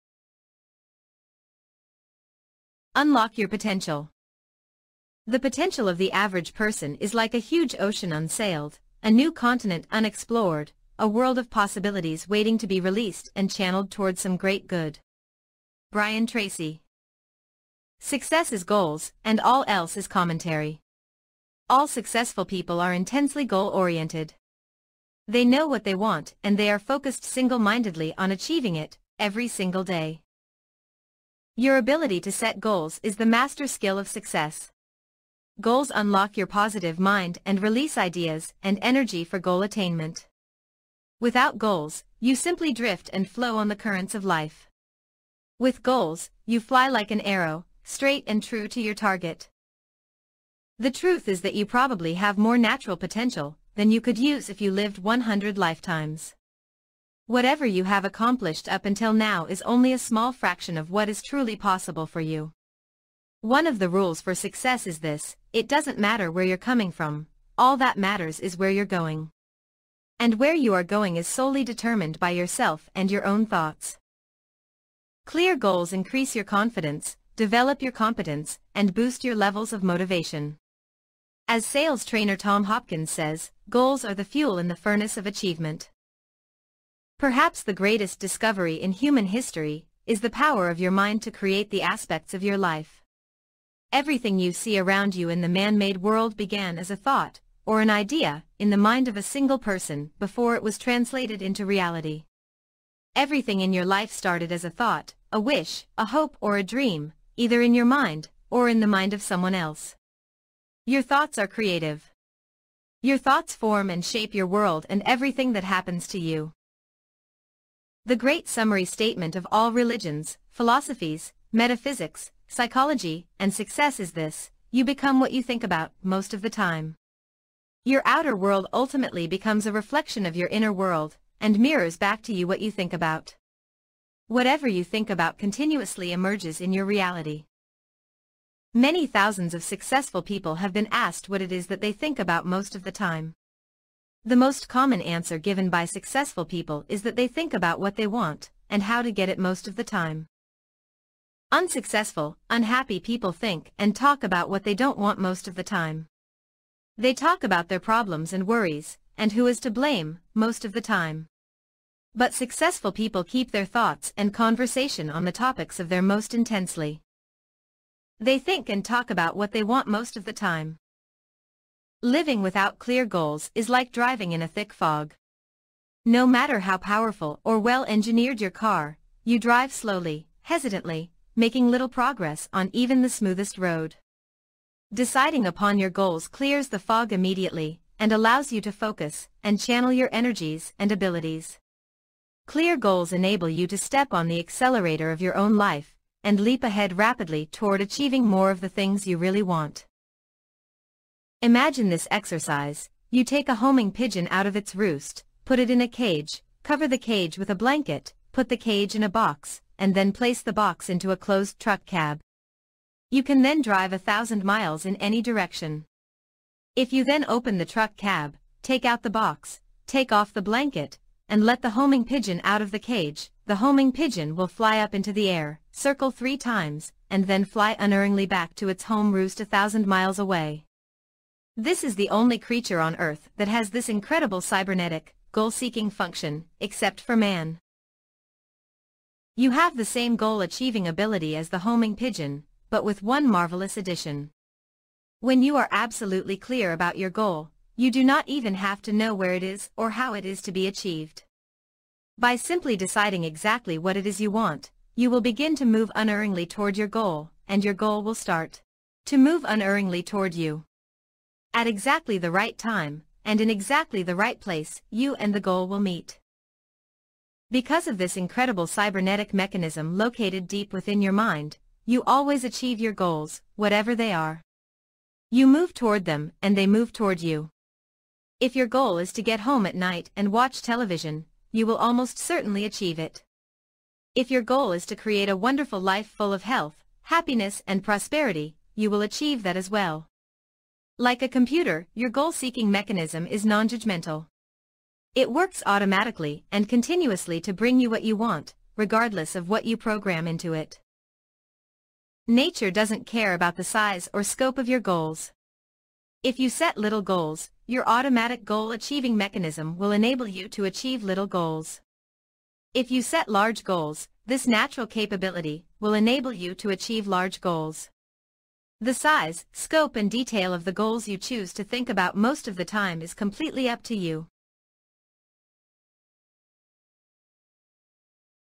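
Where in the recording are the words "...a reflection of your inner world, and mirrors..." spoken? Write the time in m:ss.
2:09.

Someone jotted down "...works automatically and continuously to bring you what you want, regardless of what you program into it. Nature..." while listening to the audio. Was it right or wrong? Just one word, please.
right.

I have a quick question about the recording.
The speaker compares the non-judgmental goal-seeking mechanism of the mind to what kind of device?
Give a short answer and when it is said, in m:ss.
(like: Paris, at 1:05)
a computer, at 4:51.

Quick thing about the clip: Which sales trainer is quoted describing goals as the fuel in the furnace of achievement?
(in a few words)
Tom Hopkins.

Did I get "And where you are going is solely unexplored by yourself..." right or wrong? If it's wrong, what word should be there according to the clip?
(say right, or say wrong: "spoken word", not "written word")
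wrong: "determined", not "unexplored".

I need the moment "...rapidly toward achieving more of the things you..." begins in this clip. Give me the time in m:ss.
3:16.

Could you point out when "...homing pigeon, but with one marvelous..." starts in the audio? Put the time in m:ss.
4:01.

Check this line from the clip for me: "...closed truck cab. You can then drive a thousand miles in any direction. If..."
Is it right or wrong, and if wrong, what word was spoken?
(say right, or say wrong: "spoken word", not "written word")
right.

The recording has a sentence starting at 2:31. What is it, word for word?
Unsuccessful, unhappy people think and talk about what they don't want most of the time.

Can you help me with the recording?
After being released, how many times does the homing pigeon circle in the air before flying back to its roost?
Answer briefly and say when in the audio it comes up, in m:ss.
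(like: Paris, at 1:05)
3, at 3:46.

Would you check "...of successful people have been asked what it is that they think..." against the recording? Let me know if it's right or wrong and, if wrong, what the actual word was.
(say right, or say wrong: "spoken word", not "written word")
right.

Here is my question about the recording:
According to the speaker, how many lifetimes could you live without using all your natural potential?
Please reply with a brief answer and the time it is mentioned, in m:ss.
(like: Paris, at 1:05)
100, at 0:55.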